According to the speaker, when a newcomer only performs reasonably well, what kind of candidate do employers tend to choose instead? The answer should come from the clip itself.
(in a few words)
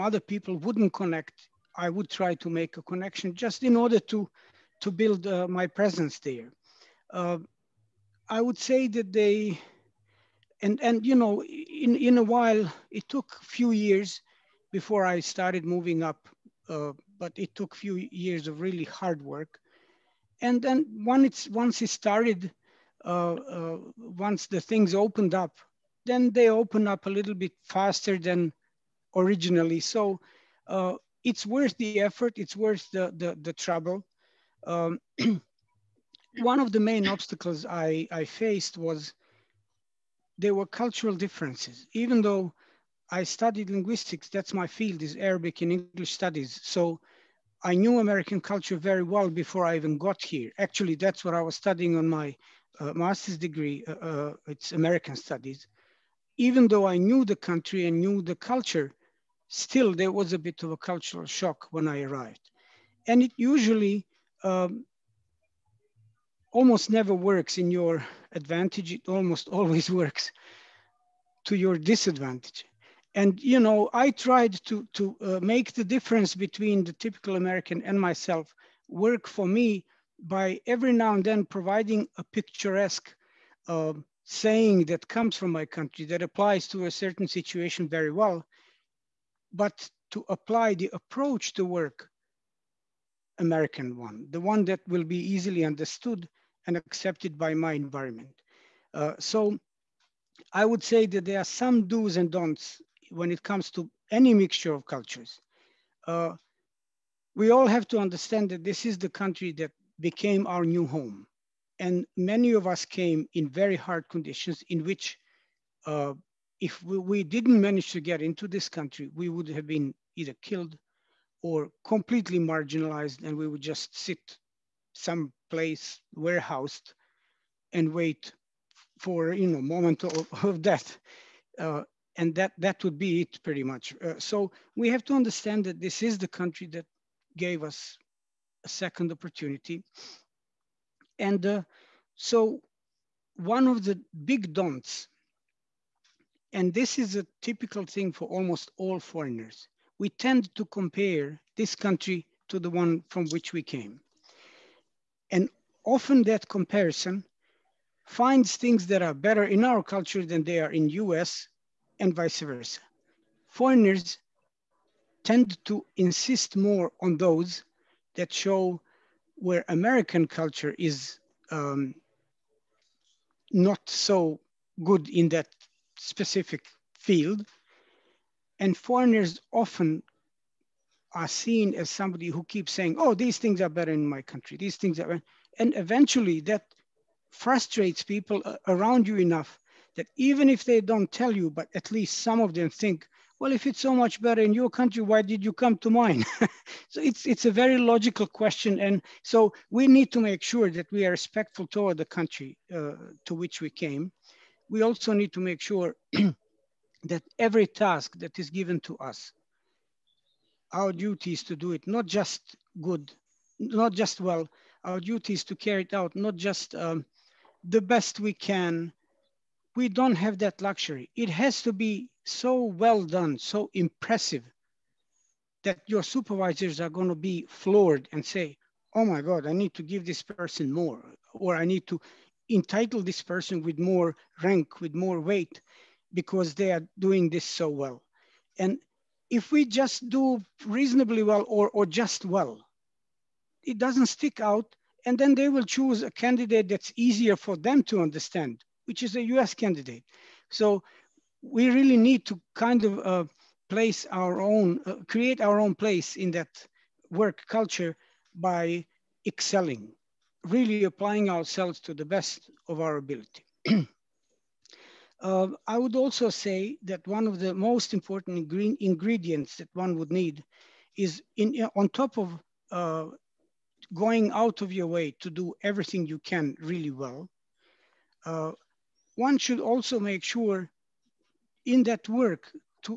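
A US candidate.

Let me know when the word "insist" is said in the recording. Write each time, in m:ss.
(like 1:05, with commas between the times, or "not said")
2:45.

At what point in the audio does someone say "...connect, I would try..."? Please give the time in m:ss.
0:00.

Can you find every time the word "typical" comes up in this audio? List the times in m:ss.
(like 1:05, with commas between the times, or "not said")
1:16, 2:27.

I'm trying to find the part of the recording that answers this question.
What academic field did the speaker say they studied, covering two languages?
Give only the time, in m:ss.
0:45.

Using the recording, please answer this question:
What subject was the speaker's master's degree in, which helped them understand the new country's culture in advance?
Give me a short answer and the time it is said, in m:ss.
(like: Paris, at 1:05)
American studies, at 0:54.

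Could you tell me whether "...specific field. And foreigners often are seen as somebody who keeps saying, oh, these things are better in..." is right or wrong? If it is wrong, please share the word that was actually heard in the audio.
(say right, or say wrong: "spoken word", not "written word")
right.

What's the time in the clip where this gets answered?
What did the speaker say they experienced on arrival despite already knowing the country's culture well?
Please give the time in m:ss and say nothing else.
1:00.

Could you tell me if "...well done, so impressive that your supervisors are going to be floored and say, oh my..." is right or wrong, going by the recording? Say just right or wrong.
right.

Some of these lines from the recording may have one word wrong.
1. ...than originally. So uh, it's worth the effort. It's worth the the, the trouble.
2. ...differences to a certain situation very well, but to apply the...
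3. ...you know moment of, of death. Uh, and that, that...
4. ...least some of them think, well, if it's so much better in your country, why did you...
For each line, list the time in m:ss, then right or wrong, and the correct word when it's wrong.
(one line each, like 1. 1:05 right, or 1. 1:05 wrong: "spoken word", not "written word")
1. 0:28 right
2. 1:26 wrong: "applies", not "differences"
3. 2:09 right
4. 3:11 right.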